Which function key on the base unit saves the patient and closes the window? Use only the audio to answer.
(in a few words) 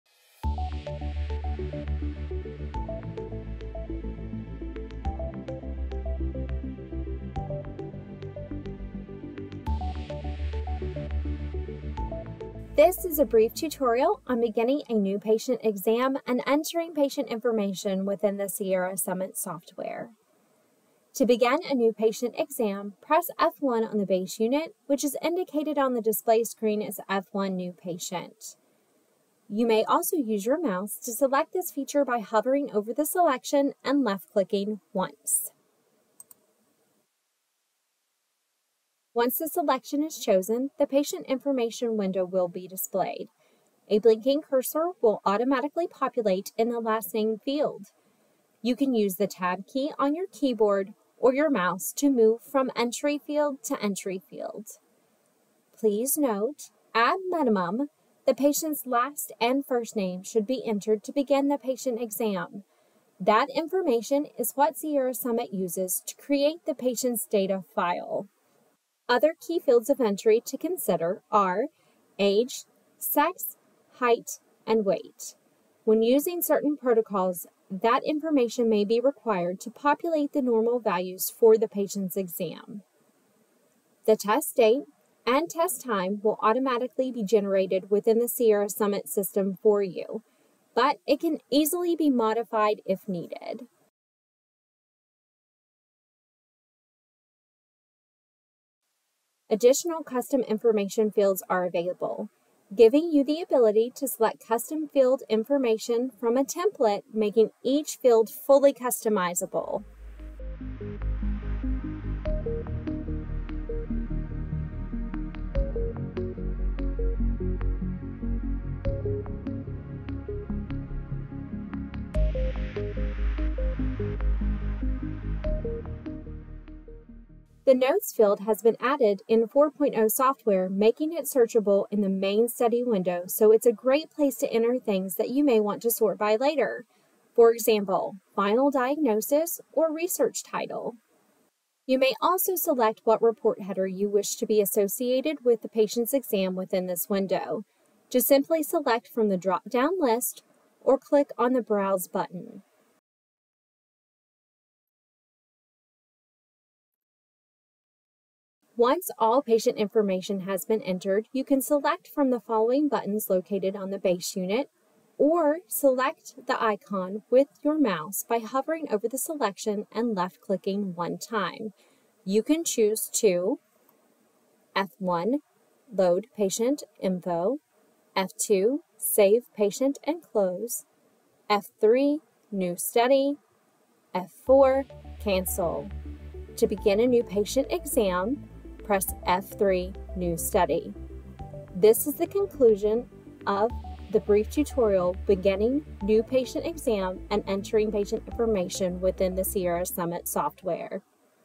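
F2.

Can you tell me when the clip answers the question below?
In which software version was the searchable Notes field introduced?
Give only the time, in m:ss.
2:09.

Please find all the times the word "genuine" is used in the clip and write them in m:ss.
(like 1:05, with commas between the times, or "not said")
not said.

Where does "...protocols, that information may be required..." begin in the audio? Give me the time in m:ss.
1:16.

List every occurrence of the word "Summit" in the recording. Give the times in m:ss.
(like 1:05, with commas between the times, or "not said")
0:18, 1:05, 1:28, 3:19.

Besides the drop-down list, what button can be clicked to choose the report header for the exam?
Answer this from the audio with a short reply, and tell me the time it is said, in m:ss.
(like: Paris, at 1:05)
Browse, at 2:31.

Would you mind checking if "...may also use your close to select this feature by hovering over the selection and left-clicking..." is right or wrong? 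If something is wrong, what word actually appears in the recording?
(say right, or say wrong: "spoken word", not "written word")
wrong: "mouse", not "close".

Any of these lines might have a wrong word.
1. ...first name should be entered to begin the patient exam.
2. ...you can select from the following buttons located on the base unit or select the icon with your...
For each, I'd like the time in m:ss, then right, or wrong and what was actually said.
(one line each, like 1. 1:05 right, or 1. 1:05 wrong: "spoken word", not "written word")
1. 0:59 right
2. 2:41 right.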